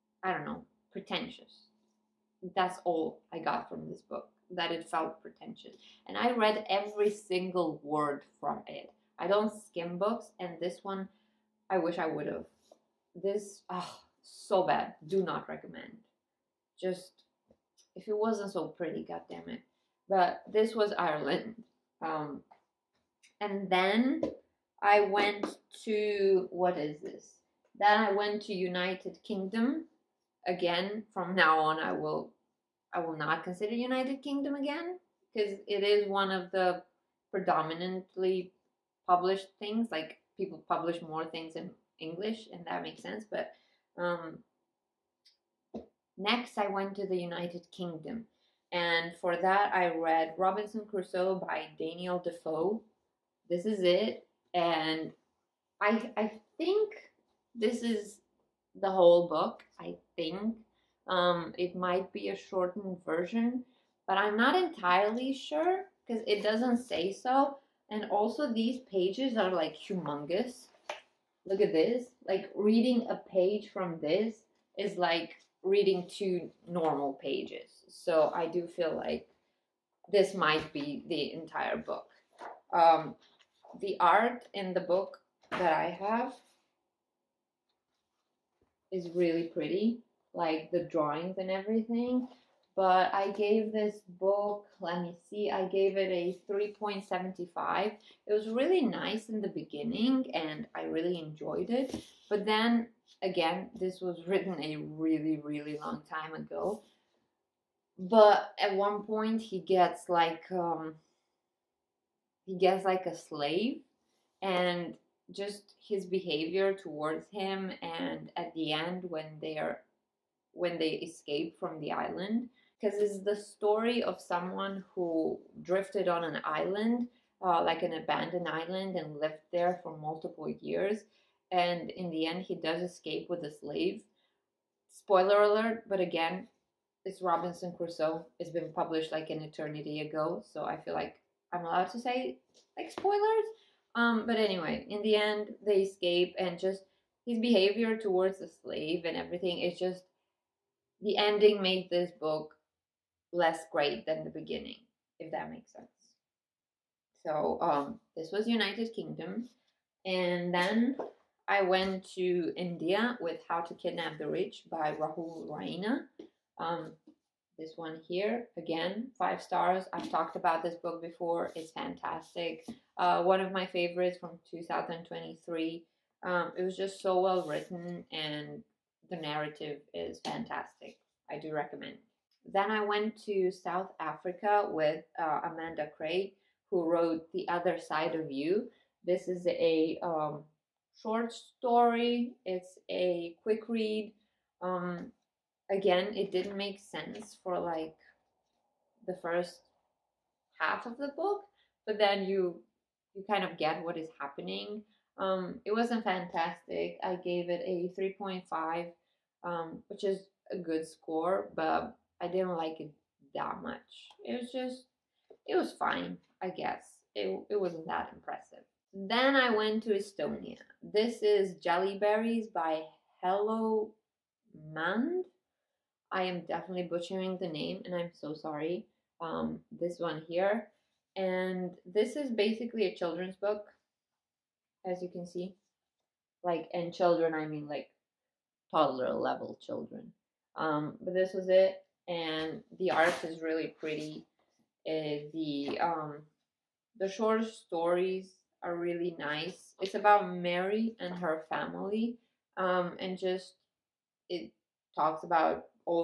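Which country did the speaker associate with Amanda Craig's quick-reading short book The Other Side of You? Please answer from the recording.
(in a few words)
South Africa.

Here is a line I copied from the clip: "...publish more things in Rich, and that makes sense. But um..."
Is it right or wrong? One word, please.
wrong.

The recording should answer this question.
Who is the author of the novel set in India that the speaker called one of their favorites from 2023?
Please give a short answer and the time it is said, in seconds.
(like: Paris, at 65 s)
Rahul Raina, at 164 s.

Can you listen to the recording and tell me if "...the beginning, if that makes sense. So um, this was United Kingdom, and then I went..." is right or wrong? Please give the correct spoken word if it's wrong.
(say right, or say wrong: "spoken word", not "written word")
right.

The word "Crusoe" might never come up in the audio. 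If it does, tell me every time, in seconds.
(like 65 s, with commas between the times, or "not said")
50 s, 137 s.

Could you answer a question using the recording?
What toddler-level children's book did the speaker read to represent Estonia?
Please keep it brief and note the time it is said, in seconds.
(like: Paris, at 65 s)
Jellyberries, at 221 s.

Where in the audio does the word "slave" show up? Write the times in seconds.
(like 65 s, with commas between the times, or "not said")
113 s, 133 s, 148 s.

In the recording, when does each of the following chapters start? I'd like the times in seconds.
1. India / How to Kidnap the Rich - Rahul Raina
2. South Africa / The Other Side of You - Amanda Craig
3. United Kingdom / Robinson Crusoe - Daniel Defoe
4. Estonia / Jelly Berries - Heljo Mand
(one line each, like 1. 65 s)
1. 161 s
2. 181 s
3. 34 s
4. 218 s.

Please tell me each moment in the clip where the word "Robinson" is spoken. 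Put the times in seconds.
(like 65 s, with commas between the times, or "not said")
50 s, 137 s.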